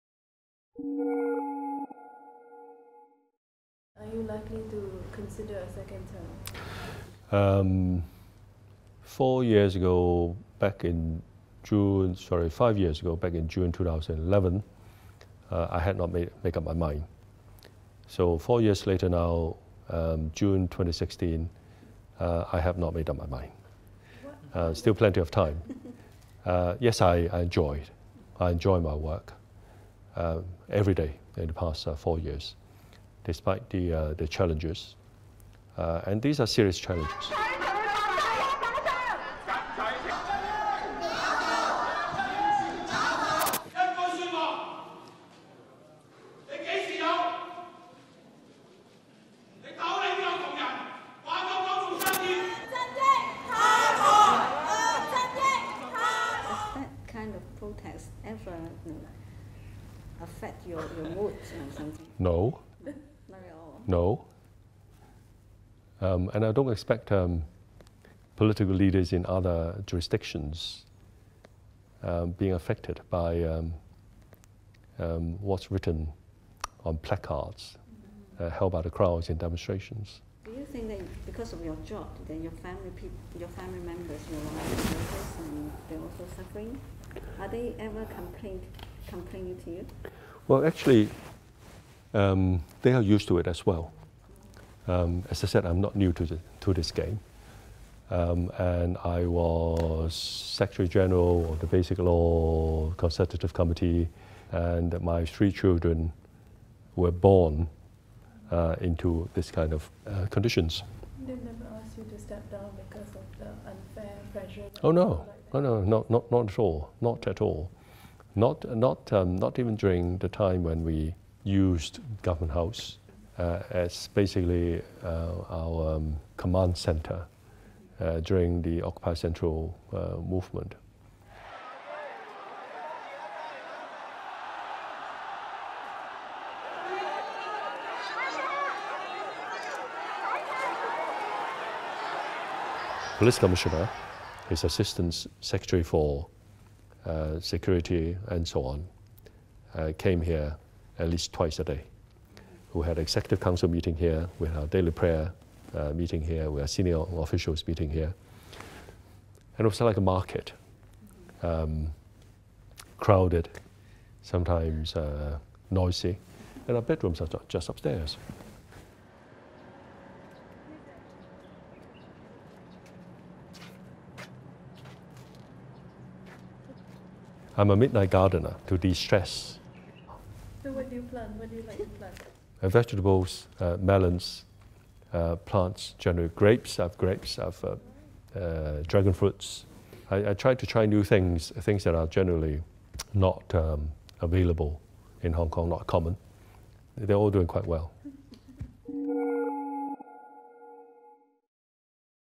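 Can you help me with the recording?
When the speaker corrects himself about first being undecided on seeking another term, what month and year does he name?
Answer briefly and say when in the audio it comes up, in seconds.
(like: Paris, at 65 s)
June 2011, at 13 s.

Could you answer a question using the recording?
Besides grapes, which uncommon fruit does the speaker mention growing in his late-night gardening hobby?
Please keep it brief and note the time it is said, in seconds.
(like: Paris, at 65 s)
Dragon fruits, at 188 s.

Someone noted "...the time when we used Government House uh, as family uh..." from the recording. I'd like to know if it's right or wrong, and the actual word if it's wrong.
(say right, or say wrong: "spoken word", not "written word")
wrong: "basically", not "family".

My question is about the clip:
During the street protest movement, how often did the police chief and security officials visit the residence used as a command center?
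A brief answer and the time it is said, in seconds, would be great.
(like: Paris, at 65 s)
At least twice a day, at 150 s.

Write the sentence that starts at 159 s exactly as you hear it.
And it was like a market, um, crowded, sometimes uh, noisy, and our bedrooms are just upstairs.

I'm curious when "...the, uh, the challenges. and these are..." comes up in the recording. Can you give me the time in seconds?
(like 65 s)
33 s.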